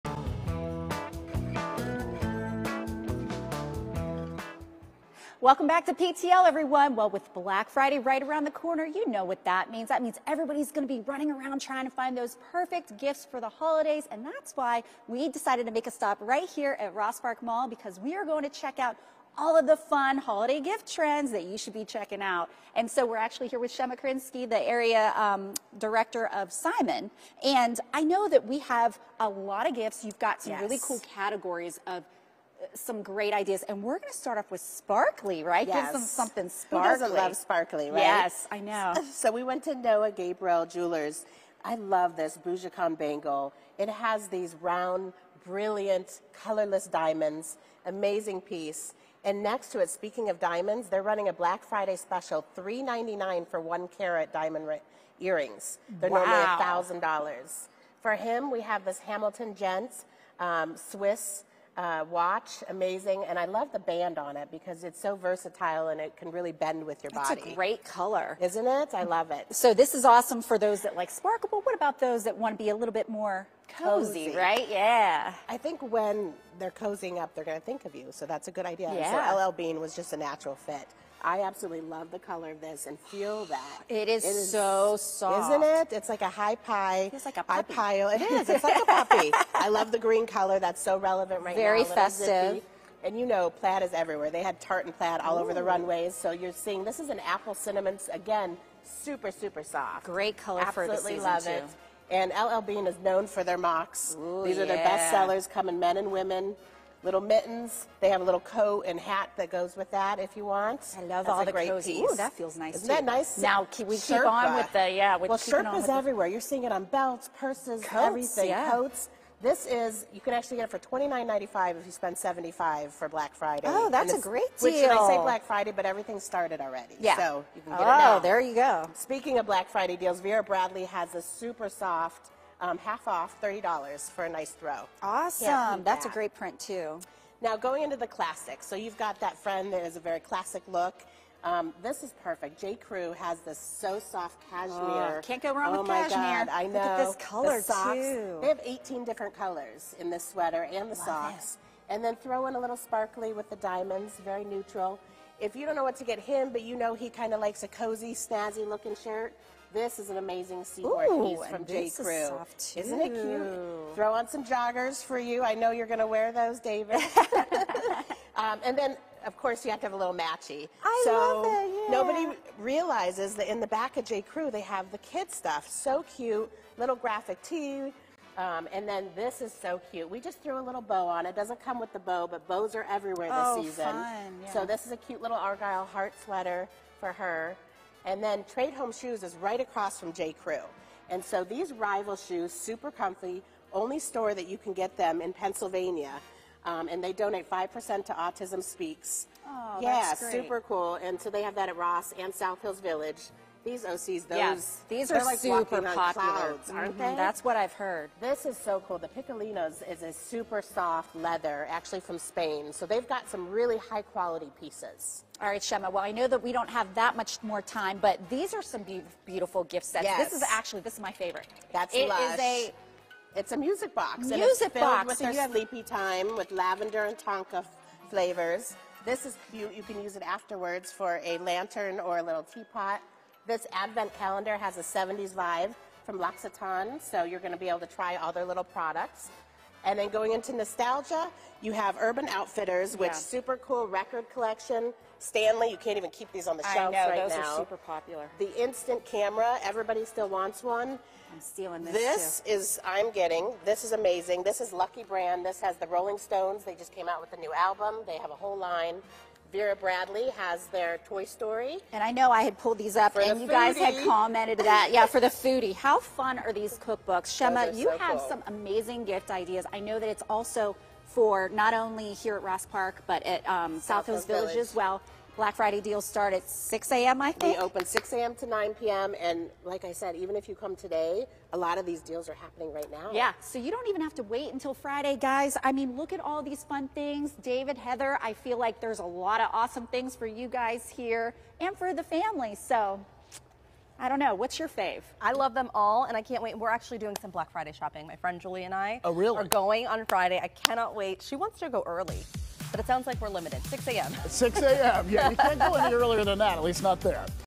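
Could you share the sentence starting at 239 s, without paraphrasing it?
And then going into nostalgia, you have Urban Outfitters, which yeah.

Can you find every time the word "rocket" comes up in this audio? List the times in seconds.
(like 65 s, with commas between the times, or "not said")
not said.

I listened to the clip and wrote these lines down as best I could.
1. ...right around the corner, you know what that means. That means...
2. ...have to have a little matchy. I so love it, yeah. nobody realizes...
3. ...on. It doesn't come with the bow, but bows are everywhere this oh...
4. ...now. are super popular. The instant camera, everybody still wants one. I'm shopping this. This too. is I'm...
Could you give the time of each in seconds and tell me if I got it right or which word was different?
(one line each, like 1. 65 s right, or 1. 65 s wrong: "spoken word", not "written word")
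1. 7 s right
2. 169 s right
3. 181 s right
4. 247 s wrong: "stealing", not "shopping".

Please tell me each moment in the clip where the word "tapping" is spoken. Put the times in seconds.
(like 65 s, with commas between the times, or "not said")
not said.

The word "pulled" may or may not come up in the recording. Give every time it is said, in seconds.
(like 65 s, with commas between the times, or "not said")
262 s.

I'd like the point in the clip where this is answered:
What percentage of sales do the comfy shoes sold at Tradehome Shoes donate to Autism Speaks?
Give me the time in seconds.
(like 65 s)
197 s.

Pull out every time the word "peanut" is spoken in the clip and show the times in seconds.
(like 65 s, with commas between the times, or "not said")
not said.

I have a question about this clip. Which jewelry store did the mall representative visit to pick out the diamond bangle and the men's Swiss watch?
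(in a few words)
Noah Gabriel Jewelers.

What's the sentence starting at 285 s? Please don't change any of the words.
I mean, look at all these fun things.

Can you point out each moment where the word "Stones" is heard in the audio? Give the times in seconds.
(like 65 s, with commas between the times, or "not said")
256 s.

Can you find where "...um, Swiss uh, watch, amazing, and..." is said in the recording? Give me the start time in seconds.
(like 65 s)
60 s.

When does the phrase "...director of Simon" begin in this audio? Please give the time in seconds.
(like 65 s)
25 s.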